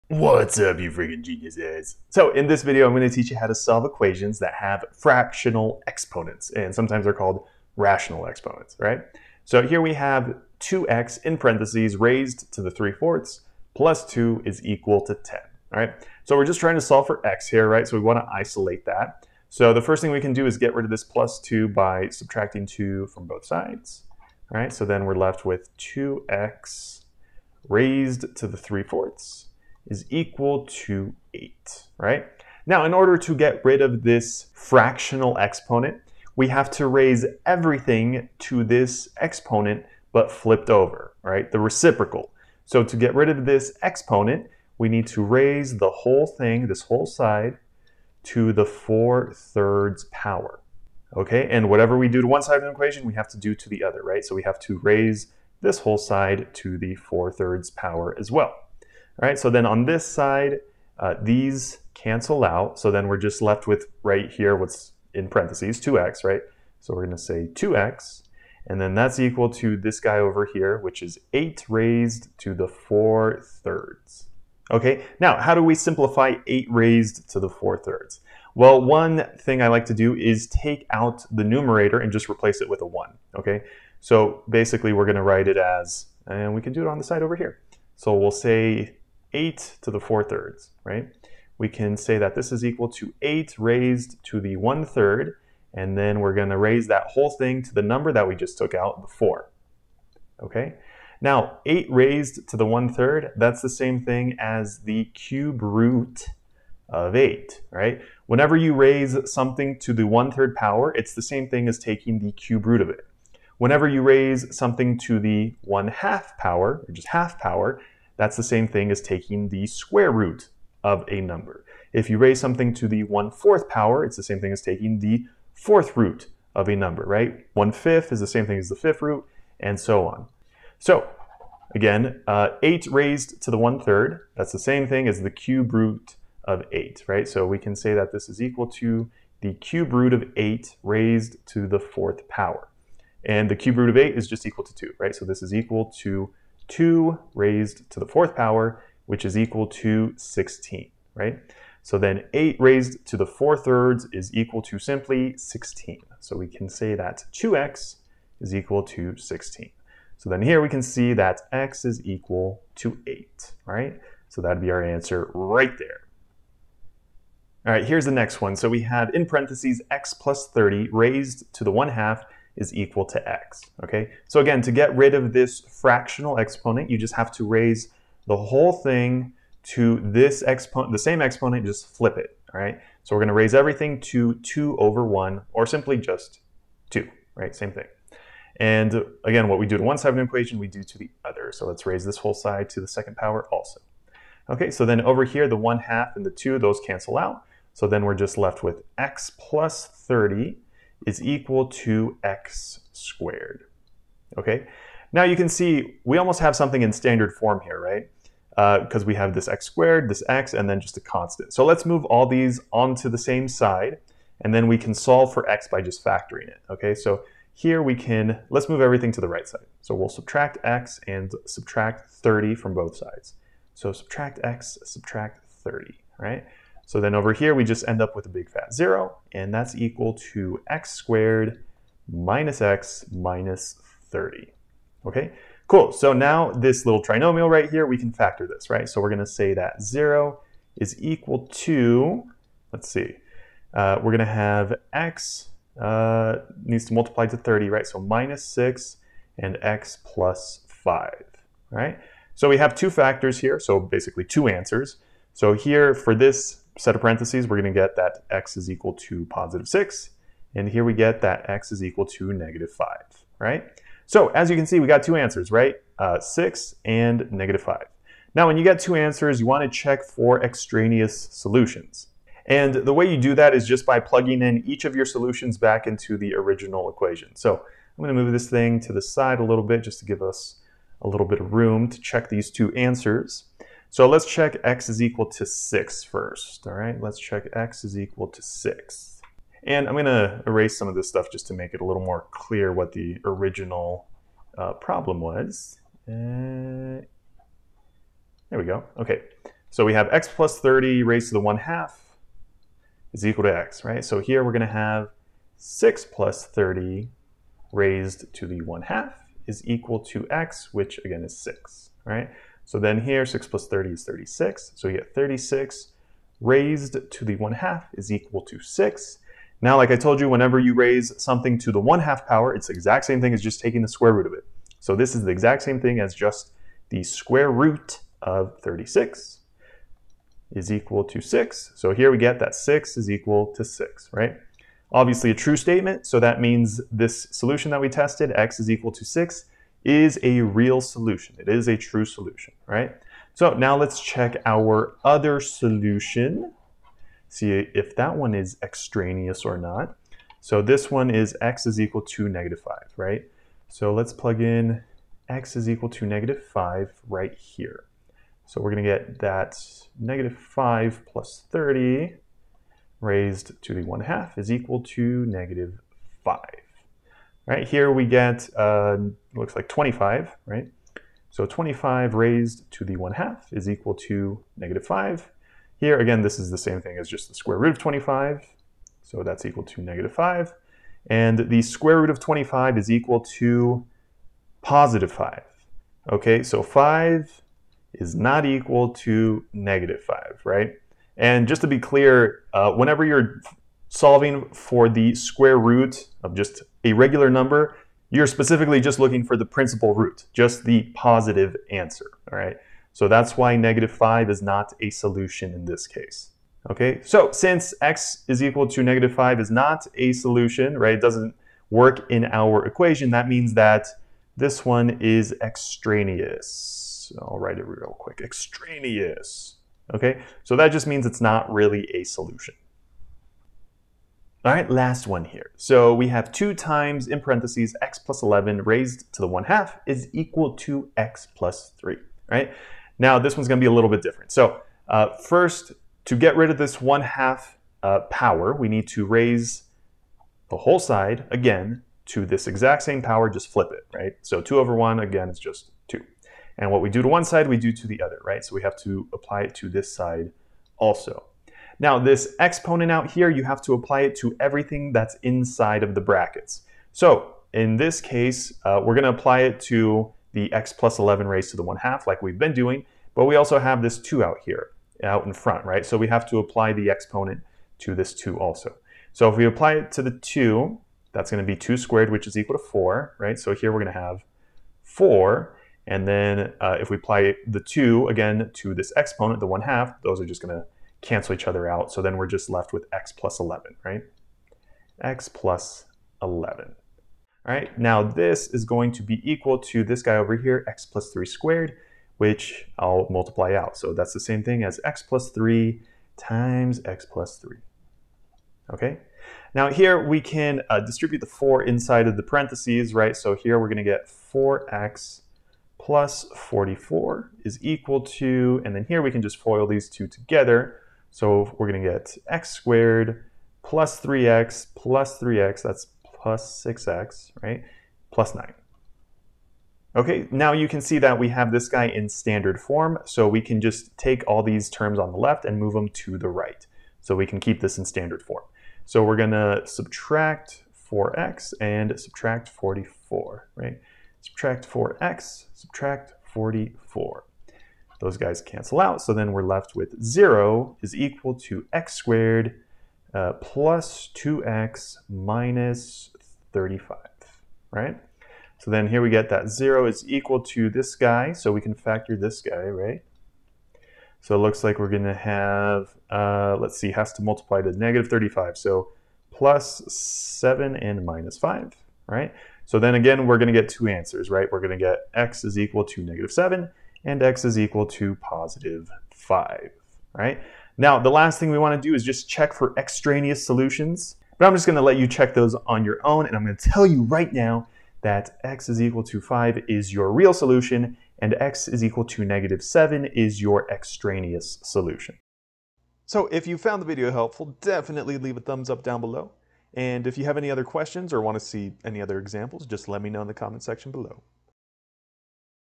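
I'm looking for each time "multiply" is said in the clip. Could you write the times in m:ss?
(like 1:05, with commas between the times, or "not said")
4:06, 8:13, 9:17.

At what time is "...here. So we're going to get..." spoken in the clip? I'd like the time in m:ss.
5:57.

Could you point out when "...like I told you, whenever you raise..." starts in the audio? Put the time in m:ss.
5:19.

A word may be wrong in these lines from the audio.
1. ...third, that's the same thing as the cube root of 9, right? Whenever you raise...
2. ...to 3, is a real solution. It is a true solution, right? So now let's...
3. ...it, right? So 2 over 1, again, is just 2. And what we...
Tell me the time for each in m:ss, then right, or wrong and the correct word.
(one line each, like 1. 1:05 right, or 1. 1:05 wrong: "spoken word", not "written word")
1. 1:42 wrong: "8", not "9"
2. 5:38 wrong: "6", not "3"
3. 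7:23 right.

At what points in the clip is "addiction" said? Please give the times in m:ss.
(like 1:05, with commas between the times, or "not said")
not said.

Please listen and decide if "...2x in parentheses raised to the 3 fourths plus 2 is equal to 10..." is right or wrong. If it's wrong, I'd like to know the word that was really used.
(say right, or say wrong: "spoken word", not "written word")
right.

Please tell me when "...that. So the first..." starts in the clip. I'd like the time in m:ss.
0:18.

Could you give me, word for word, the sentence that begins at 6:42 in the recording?
So that's why negative 5 is not a solution in this case.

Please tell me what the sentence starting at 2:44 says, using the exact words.
So that'd be our answer right there.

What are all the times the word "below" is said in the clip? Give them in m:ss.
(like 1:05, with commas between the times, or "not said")
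9:49, 9:53.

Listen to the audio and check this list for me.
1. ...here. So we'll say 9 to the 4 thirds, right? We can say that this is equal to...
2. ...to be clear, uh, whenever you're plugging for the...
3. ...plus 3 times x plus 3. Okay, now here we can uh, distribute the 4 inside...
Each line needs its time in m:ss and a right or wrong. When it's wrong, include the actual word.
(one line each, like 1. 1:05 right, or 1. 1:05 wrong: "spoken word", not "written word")
1. 1:27 wrong: "8", not "9"
2. 6:31 wrong: "solving", not "plugging"
3. 8:15 right.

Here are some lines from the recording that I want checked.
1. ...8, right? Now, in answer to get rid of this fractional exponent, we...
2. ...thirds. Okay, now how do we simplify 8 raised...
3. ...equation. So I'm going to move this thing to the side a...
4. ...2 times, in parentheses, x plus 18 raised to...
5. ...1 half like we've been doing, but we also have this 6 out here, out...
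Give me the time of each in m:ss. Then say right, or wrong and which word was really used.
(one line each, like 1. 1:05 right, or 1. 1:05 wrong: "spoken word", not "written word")
1. 0:31 wrong: "order", not "answer"
2. 1:13 right
3. 4:36 right
4. 7:06 wrong: "11", not "18"
5. 7:41 wrong: "2", not "6".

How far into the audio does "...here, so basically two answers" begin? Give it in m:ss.
4:13.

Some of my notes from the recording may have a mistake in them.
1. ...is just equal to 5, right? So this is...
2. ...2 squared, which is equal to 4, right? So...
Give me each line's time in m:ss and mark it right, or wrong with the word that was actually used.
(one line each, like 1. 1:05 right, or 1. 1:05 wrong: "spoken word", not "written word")
1. 2:24 wrong: "2", not "5"
2. 7:51 right.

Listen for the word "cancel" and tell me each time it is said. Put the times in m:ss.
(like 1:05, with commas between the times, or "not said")
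1:01, 3:16, 8:01, 8:58.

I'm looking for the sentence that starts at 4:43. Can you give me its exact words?
So let's check x is equal to 6 first, all right?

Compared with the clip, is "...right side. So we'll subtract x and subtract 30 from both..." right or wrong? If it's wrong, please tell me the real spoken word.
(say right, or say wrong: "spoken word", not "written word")
right.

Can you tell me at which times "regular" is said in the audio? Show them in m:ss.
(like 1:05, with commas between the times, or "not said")
6:36.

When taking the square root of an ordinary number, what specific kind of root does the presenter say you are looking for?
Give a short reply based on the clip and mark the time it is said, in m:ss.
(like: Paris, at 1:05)
principal root, at 6:39.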